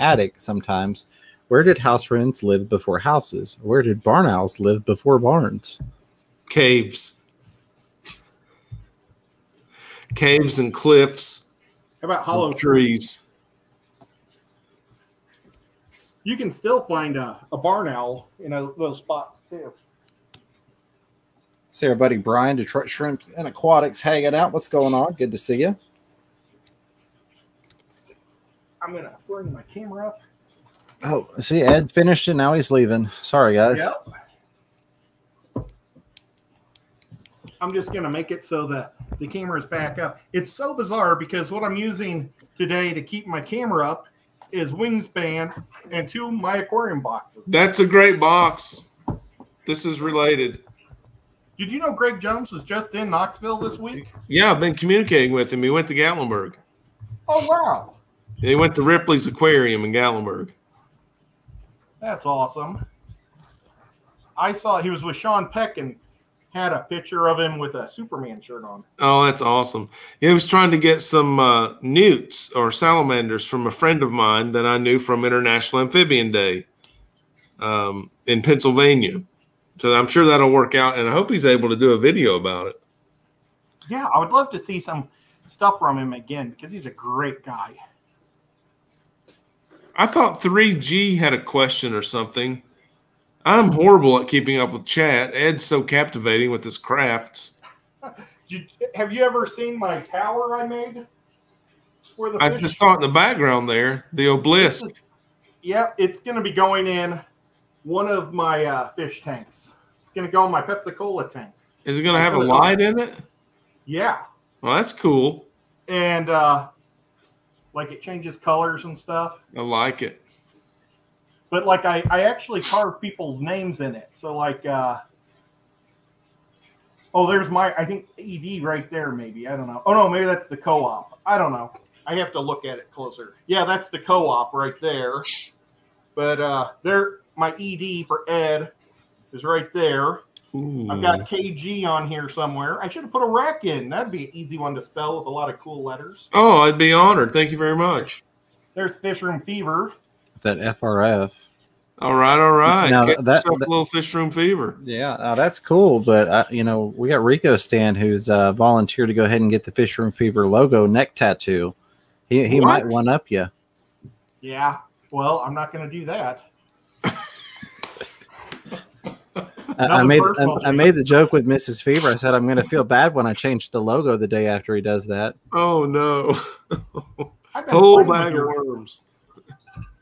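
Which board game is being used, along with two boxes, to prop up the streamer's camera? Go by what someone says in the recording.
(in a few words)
Wingspan.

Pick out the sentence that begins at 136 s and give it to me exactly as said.
But uh, there my ED for Ed is right there.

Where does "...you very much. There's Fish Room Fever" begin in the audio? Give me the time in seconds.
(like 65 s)
147 s.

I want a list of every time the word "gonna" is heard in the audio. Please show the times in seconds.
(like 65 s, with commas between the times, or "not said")
28 s, 37 s.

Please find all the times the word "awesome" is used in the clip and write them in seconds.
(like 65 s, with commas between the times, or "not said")
62 s, 69 s.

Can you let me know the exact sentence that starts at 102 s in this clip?
Where the I just saw in the background there the obelisk.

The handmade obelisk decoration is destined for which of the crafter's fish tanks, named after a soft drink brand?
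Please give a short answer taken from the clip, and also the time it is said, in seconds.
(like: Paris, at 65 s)
Pepsi Cola tank, at 110 s.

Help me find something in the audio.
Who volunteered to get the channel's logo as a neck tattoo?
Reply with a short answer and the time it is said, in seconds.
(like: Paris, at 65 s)
Rico Stan, at 157 s.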